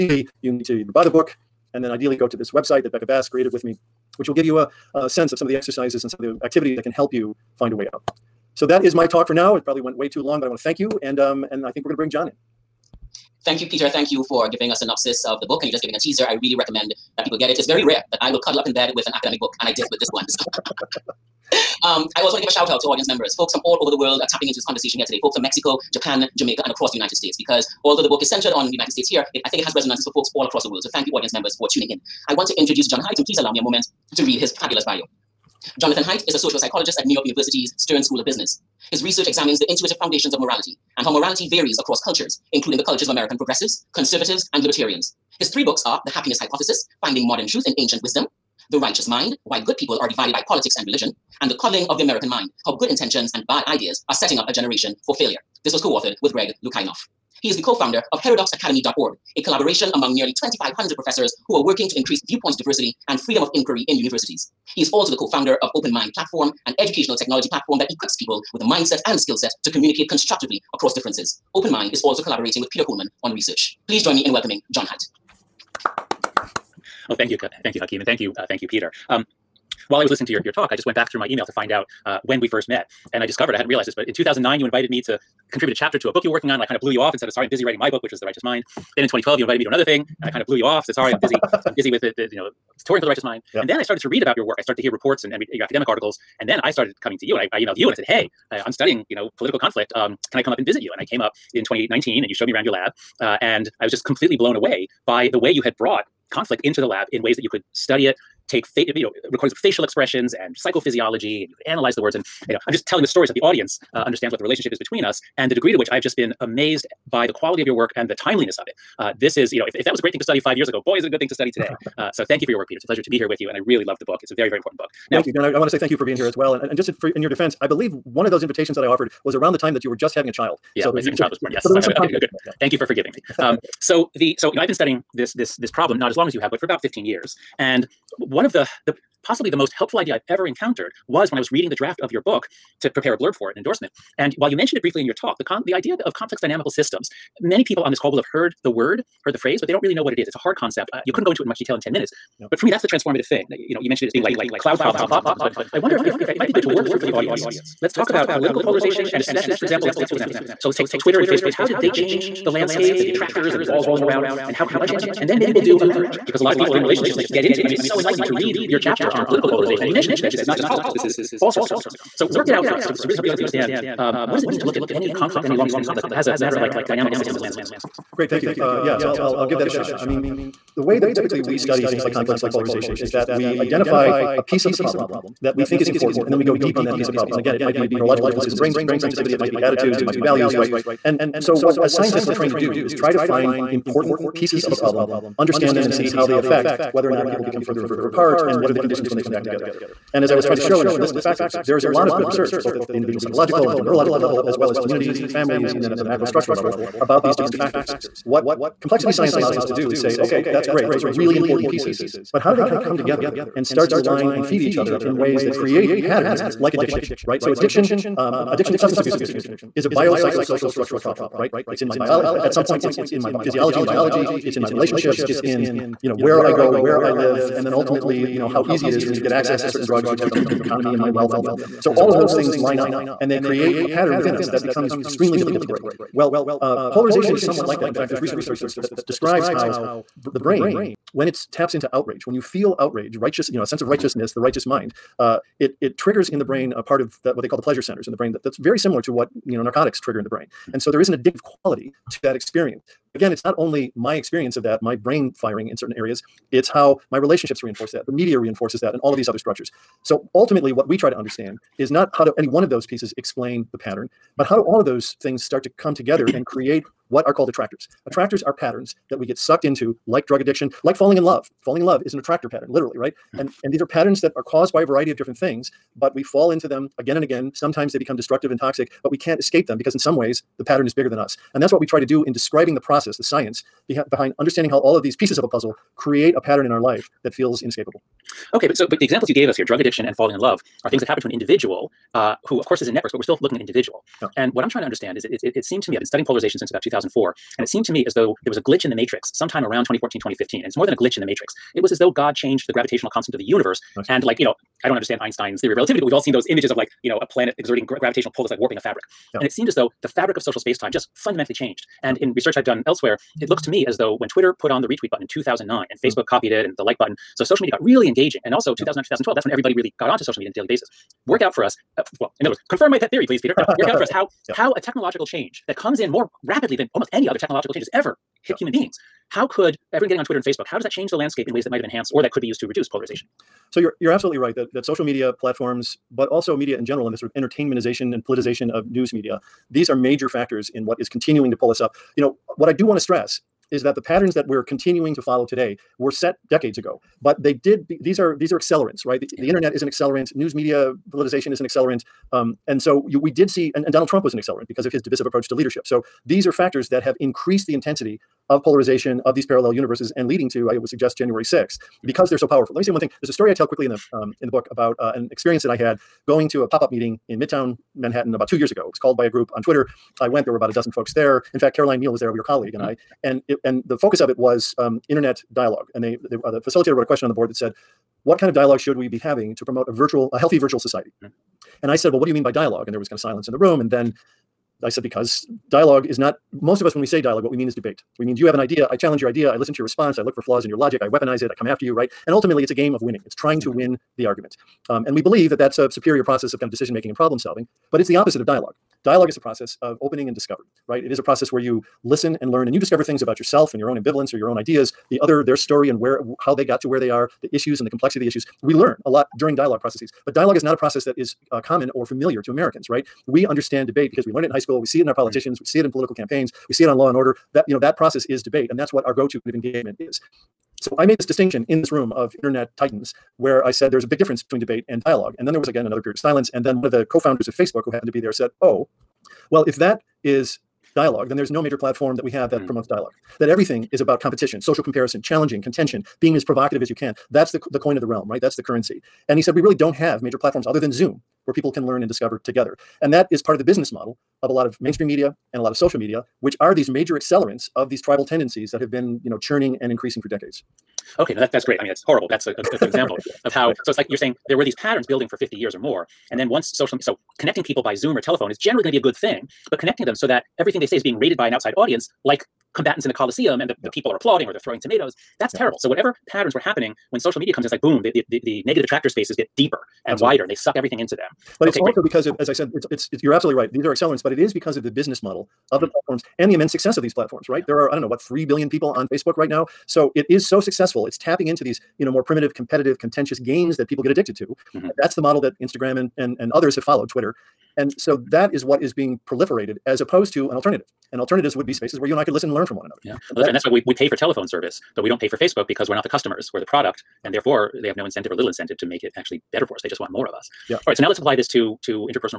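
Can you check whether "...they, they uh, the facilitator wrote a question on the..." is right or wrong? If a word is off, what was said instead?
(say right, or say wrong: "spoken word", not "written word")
right.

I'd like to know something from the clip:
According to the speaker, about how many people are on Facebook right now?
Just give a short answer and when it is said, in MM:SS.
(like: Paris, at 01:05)
3 billion, at 07:58.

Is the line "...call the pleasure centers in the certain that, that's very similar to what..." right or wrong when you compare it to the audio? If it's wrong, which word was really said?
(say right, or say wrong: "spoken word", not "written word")
wrong: "brain", not "certain".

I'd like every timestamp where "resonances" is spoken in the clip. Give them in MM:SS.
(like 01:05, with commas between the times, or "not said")
00:29.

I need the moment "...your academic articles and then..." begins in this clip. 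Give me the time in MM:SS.
01:35.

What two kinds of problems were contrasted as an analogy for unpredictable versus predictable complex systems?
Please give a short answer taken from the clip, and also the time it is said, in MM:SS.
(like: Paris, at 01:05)
cloud problems and clock problems, at 02:34.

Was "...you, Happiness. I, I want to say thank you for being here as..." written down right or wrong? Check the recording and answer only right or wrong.
wrong.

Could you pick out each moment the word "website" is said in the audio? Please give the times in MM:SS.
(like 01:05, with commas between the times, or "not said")
00:02.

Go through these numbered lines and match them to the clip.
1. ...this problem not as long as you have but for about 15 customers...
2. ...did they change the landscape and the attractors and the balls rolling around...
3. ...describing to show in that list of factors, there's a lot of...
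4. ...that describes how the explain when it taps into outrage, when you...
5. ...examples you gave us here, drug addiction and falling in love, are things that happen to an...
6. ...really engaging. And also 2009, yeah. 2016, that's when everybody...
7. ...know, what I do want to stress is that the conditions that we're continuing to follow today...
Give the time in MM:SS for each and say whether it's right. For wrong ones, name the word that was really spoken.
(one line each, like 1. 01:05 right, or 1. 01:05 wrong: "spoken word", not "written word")
1. 02:15 wrong: "years", not "customers"
2. 02:41 right
3. 03:20 wrong: "trying", not "describing"
4. 03:58 wrong: "brain", not "explain"
5. 04:49 right
6. 05:17 wrong: "2012", not "2016"
7. 05:42 wrong: "patterns", not "conditions".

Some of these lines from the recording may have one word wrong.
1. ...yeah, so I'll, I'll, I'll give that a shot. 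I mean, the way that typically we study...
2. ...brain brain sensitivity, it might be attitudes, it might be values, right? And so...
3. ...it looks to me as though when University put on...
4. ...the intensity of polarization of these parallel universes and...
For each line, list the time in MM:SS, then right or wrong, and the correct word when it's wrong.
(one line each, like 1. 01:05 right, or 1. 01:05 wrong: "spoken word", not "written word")
1. 02:58 right
2. 03:08 right
3. 05:13 wrong: "Twitter", not "University"
4. 05:57 right.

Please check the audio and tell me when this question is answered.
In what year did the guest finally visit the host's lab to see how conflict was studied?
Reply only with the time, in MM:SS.
01:41.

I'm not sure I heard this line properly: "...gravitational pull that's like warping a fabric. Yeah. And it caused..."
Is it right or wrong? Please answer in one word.
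wrong.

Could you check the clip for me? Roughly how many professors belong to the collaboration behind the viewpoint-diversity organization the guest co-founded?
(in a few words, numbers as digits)
2,500.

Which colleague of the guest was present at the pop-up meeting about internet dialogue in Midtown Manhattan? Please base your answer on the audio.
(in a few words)
Caroline Mehl.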